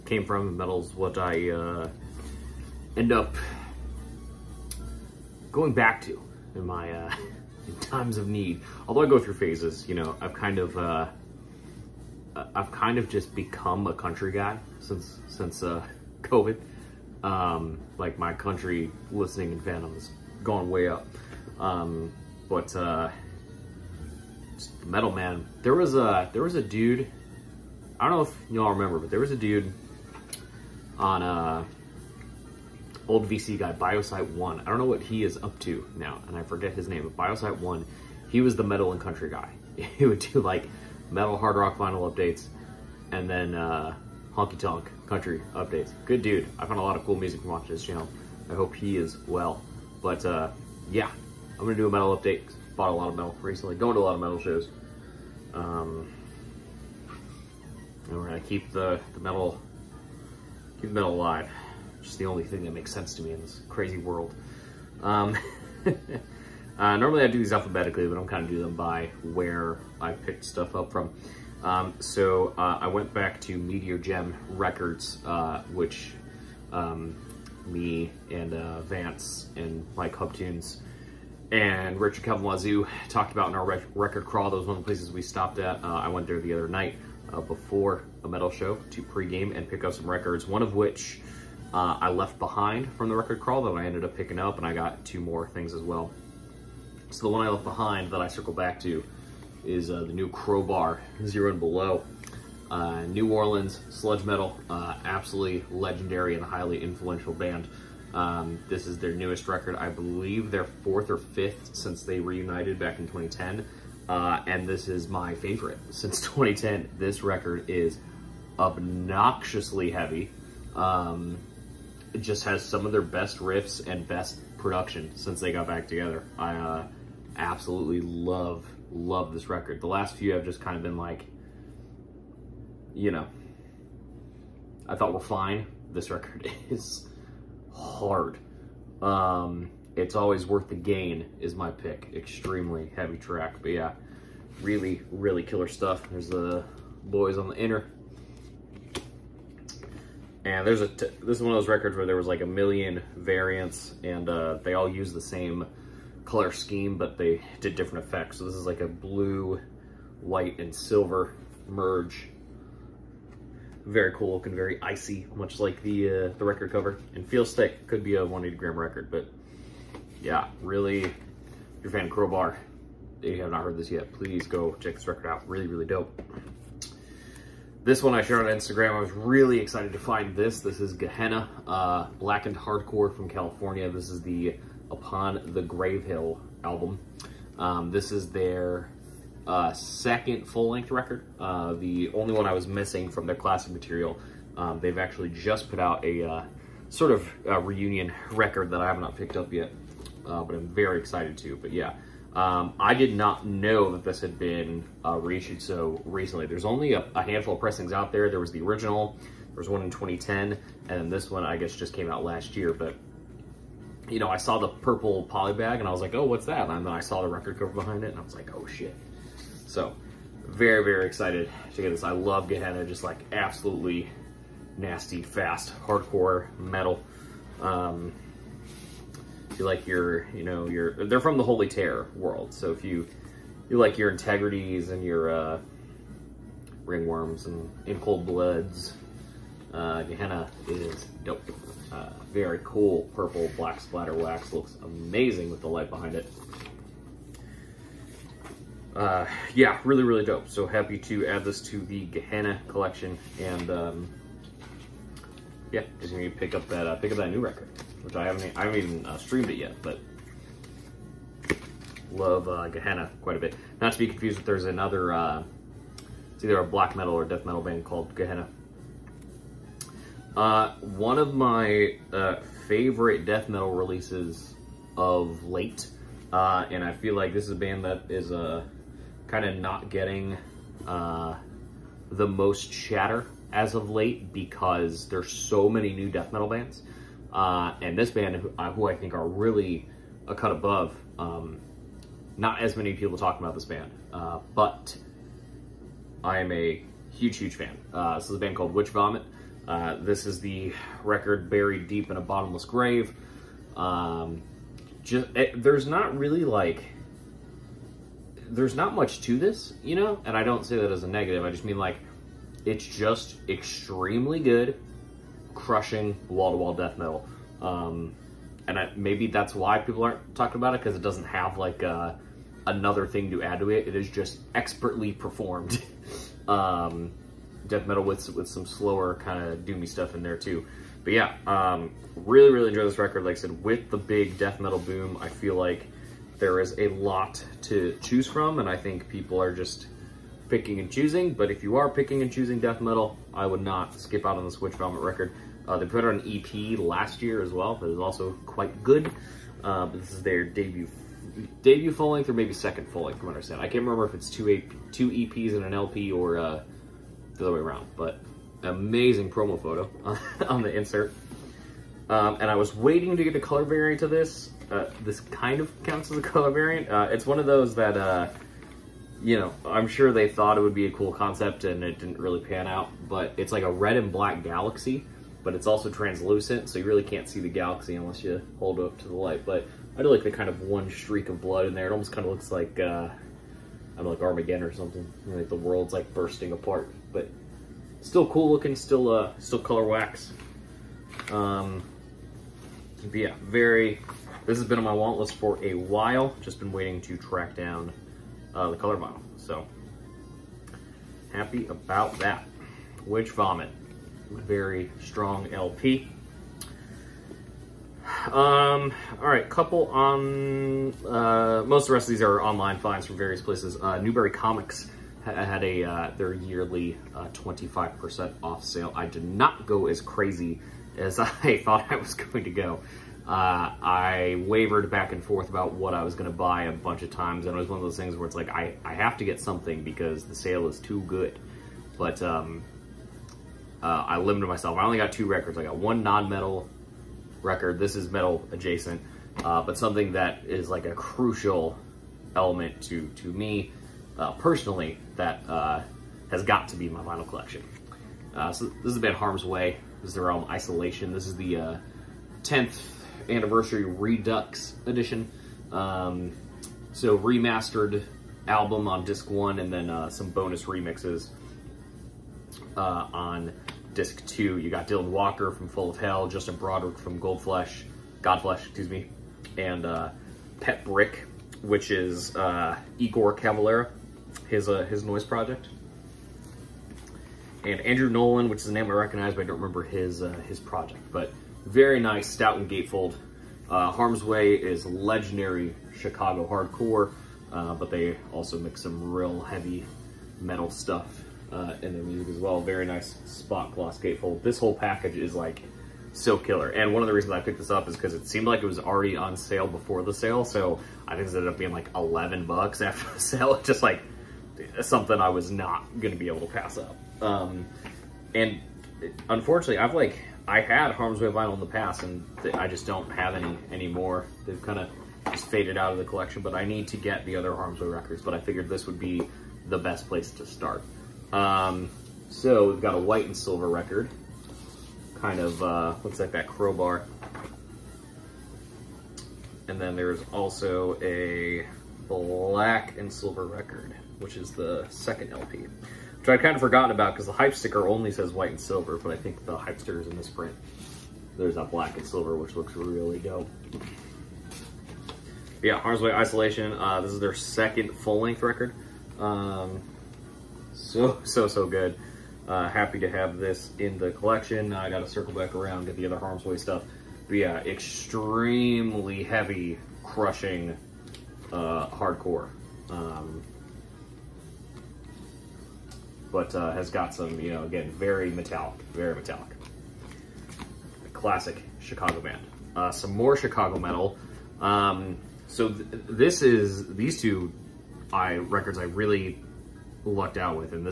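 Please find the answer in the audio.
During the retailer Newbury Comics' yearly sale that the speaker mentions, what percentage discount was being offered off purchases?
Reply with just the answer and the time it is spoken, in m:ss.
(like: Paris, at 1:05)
25%, at 6:57.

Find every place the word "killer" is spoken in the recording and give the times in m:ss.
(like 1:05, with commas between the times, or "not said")
2:25, 8:16.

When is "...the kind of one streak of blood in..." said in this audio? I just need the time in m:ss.
6:20.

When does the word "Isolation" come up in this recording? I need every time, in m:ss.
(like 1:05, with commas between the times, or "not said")
7:30, 9:06.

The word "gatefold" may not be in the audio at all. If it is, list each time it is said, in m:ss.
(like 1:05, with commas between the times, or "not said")
8:02, 8:13.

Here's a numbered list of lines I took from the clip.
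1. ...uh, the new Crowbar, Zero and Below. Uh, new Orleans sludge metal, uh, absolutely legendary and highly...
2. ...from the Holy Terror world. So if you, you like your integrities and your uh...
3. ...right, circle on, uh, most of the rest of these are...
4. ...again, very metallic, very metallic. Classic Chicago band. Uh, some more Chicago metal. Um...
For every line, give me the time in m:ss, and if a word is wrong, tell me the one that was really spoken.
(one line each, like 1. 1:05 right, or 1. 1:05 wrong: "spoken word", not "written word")
1. 1:39 right
2. 3:51 right
3. 6:49 wrong: "couple", not "circle"
4. 9:27 right.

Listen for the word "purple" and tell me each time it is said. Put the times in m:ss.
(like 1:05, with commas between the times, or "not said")
3:34, 4:03.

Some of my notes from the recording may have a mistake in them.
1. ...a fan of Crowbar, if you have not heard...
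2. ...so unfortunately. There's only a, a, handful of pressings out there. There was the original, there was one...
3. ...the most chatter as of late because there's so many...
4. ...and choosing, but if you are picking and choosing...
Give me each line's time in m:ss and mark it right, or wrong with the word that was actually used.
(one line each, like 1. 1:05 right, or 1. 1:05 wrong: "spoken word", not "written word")
1. 2:51 right
2. 3:25 wrong: "recently", not "unfortunately"
3. 4:42 right
4. 5:40 right.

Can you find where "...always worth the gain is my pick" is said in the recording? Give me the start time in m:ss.
2:20.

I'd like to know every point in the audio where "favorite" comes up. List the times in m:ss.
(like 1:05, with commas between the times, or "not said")
1:55, 4:32.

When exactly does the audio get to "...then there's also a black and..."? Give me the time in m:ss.
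8:49.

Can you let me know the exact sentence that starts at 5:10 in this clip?
And I don't say that as a negative.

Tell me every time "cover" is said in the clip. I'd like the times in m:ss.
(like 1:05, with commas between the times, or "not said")
2:46, 3:37.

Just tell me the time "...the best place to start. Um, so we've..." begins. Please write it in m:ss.
8:39.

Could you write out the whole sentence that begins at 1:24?
That was one of the places we stopped at.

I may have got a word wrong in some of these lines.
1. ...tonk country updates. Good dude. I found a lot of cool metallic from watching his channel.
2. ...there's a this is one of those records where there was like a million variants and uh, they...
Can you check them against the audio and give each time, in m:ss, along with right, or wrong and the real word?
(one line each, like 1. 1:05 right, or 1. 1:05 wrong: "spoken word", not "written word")
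1. 0:44 wrong: "music", not "metallic"
2. 2:30 right.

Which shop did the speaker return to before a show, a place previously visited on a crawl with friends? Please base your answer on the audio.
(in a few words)
Meteor Gem Records.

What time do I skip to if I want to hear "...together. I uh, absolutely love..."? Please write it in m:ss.
2:05.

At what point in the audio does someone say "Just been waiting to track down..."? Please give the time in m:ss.
6:36.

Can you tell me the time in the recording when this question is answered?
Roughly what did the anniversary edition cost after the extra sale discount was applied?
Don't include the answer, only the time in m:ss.
8:21.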